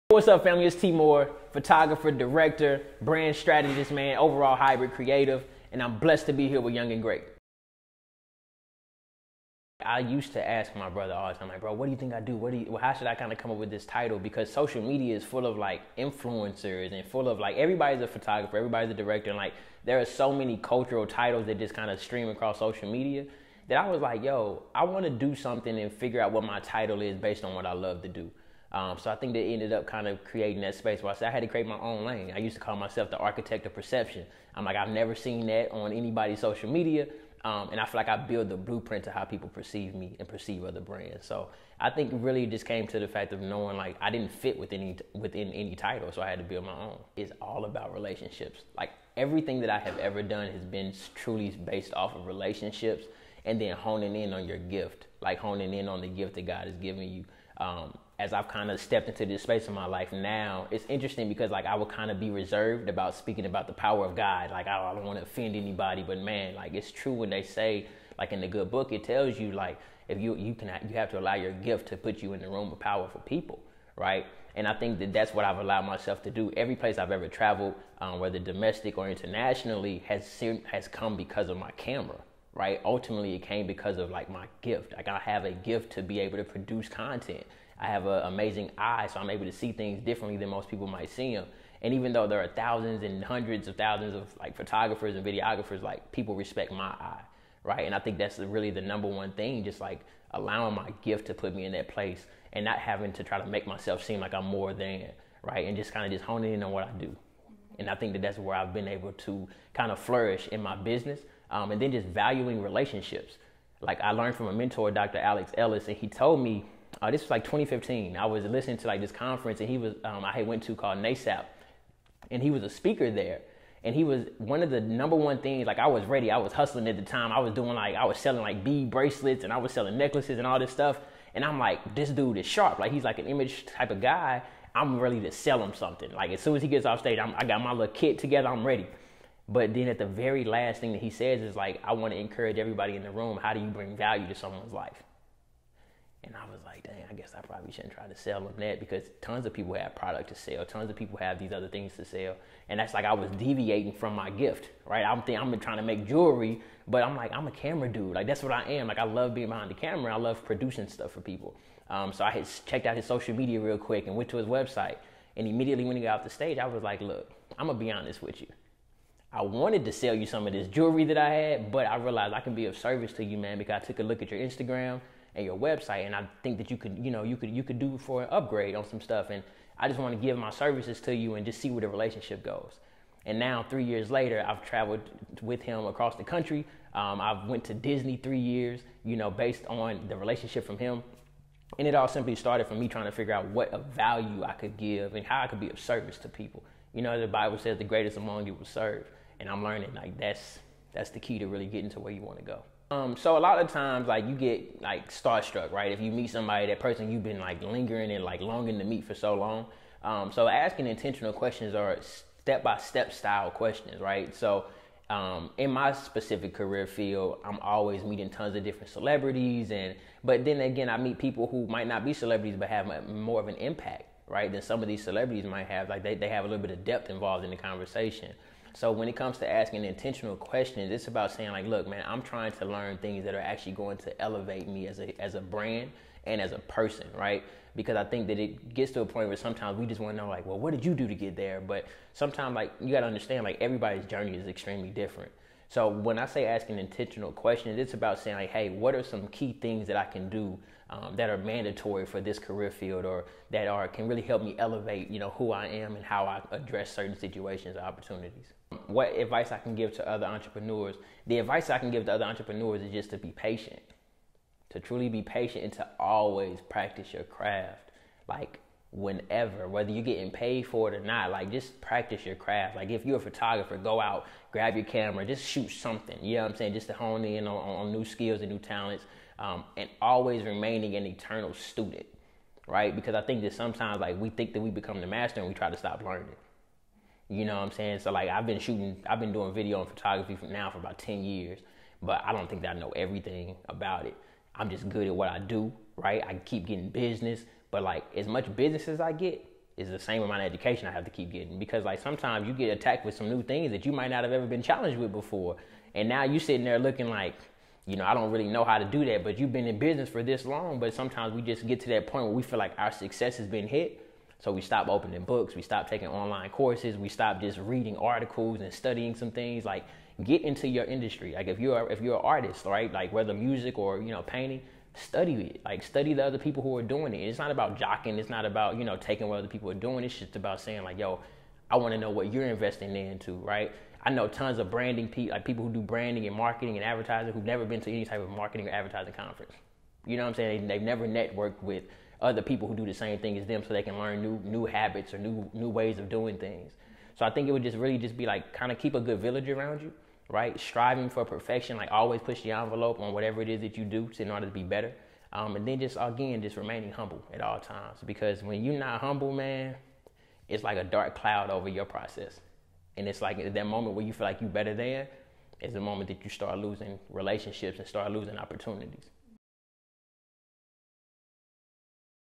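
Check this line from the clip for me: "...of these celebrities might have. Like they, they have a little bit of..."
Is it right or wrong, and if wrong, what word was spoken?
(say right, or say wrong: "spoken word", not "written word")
right.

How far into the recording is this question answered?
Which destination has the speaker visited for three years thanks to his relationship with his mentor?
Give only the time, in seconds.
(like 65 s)
187 s.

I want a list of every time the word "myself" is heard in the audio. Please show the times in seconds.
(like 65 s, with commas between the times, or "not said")
32 s, 75 s, 103 s.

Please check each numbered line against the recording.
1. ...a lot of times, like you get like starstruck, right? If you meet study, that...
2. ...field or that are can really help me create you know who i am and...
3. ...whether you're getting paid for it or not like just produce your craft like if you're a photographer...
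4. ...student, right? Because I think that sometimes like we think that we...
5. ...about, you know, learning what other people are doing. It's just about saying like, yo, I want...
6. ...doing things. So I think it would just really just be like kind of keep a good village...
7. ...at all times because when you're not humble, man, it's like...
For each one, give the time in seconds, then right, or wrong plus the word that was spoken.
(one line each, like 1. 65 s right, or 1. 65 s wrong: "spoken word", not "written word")
1. 203 s wrong: "somebody", not "study"
2. 252 s wrong: "elevate", not "create"
3. 269 s wrong: "practice", not "produce"
4. 281 s right
5. 328 s wrong: "taking", not "learning"
6. 346 s right
7. 357 s right.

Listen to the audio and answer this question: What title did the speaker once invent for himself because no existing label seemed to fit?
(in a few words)
architect of perception.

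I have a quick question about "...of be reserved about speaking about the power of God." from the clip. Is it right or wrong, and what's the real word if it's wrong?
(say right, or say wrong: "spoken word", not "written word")
right.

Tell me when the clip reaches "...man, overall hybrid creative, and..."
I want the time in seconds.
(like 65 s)
3 s.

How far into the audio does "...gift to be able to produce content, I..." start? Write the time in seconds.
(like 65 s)
85 s.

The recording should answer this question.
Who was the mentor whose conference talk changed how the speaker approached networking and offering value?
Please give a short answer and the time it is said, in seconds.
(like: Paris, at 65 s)
Dr. Alex Ellis, at 114 s.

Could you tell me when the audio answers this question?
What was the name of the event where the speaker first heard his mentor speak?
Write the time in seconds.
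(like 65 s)
120 s.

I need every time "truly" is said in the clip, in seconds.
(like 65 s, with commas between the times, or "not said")
51 s, 264 s.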